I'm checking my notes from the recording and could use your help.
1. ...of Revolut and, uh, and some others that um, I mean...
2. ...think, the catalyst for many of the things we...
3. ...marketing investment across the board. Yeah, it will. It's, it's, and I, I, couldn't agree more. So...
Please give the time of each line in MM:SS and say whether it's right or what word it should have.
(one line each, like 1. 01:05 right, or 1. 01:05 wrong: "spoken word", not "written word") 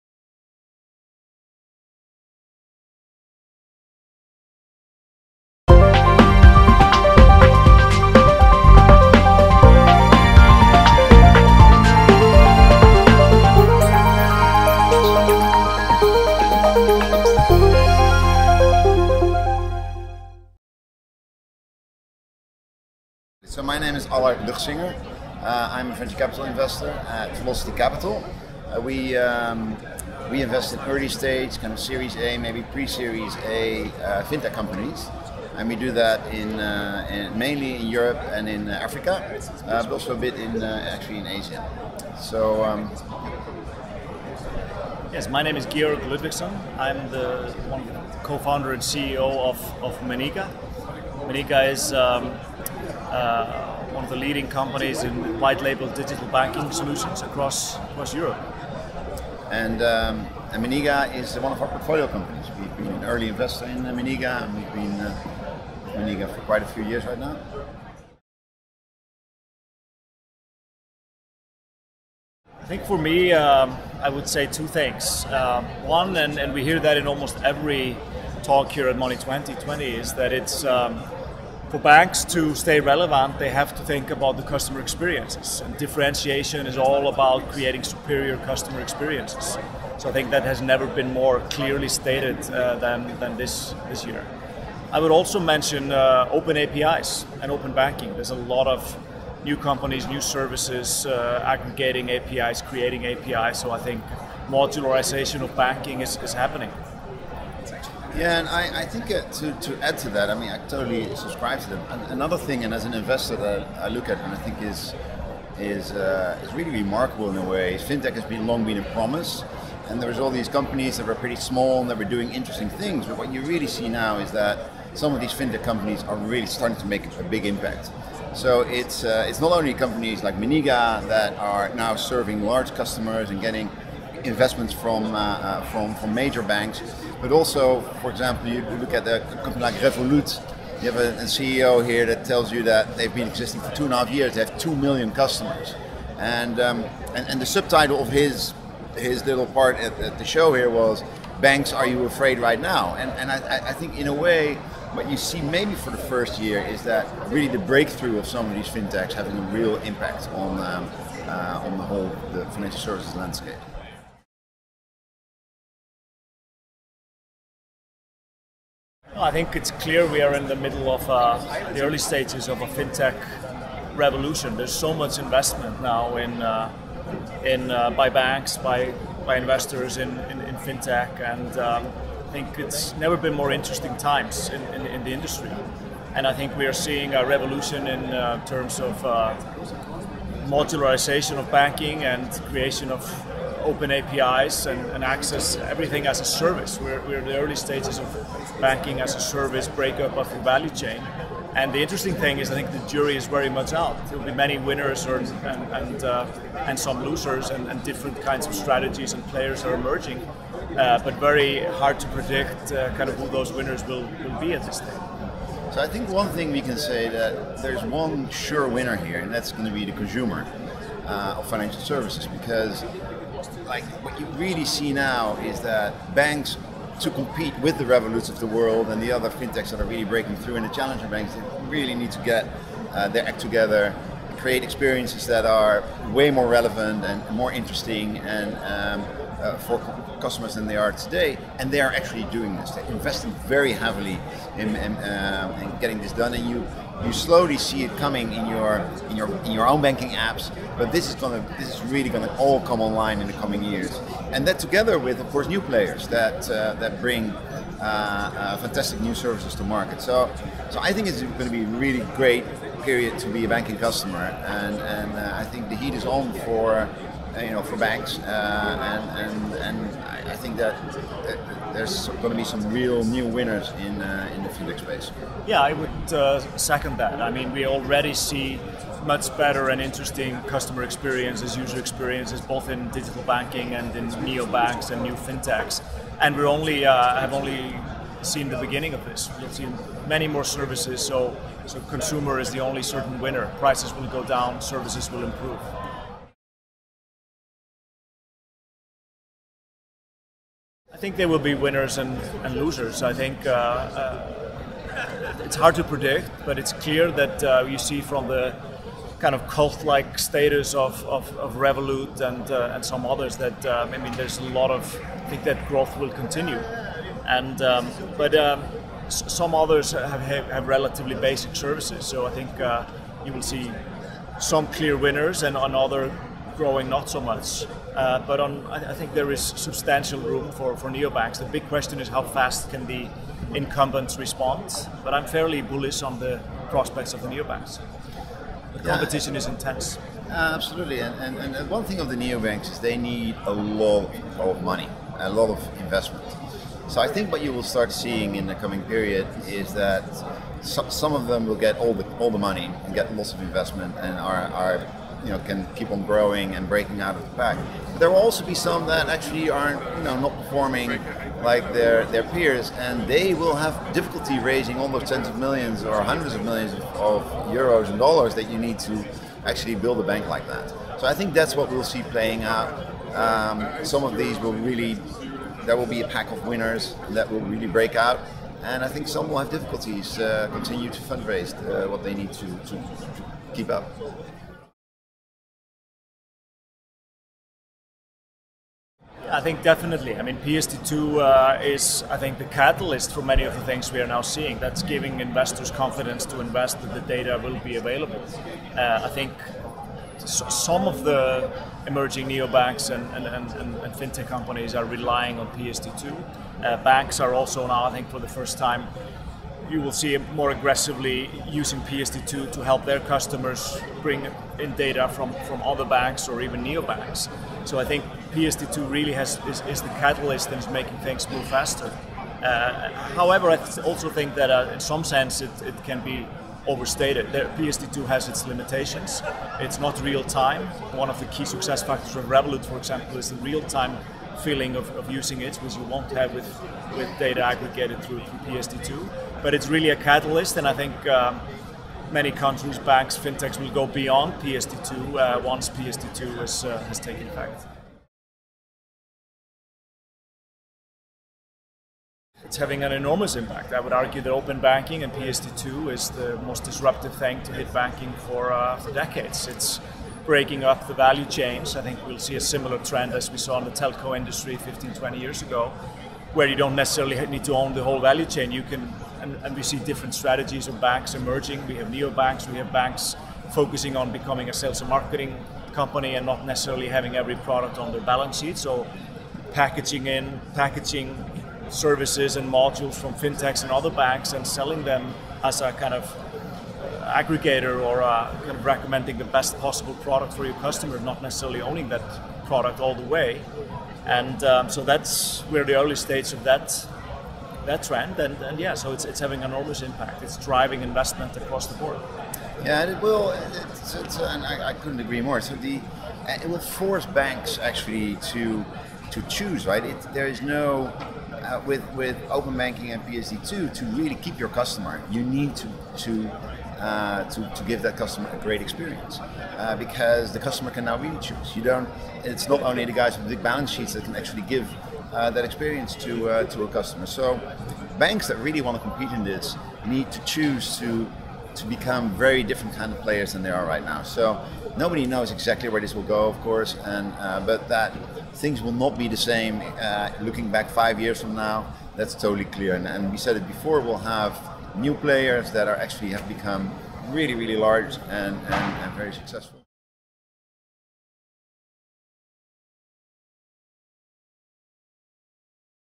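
1. 05:11 right
2. 06:32 right
3. 08:20 wrong: "driving", not "marketing".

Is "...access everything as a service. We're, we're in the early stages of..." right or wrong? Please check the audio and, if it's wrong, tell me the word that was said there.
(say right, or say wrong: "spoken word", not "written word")
right.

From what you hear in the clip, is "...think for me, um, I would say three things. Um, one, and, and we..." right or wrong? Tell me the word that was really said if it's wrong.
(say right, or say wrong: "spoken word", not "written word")
wrong: "two", not "three".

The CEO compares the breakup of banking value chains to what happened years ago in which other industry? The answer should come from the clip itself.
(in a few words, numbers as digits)
telco industry.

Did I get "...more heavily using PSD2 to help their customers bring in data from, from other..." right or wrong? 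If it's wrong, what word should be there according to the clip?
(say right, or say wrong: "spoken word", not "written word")
wrong: "aggressively", not "heavily".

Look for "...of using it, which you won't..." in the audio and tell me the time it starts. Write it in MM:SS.
07:14.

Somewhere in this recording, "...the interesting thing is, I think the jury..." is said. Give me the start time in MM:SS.
03:21.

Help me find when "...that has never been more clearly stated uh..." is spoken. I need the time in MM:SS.
01:30.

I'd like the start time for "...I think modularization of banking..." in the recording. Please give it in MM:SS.
01:43.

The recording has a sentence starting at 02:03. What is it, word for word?
But what you really see now is that some of these fintech companies are really starting to make a big impact.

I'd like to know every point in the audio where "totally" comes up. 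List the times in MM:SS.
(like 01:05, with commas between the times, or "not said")
01:50, 09:02.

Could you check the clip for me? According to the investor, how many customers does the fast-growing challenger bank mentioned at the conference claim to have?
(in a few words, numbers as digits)
2 million.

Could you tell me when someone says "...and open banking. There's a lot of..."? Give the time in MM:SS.
01:37.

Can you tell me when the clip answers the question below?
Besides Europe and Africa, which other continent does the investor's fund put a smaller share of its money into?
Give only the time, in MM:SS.
00:41.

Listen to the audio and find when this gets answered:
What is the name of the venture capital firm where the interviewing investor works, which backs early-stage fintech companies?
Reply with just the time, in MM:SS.
00:27.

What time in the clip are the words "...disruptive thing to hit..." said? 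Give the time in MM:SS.
07:36.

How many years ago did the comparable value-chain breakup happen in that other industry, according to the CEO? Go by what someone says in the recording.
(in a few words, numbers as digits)
15 to 20.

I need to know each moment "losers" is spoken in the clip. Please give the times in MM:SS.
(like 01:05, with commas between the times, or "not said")
03:27, 05:02.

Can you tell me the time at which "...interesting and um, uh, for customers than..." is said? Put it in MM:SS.
03:57.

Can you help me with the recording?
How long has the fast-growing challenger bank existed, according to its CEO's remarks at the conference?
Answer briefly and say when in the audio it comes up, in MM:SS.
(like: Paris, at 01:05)
2.5 years, at 02:23.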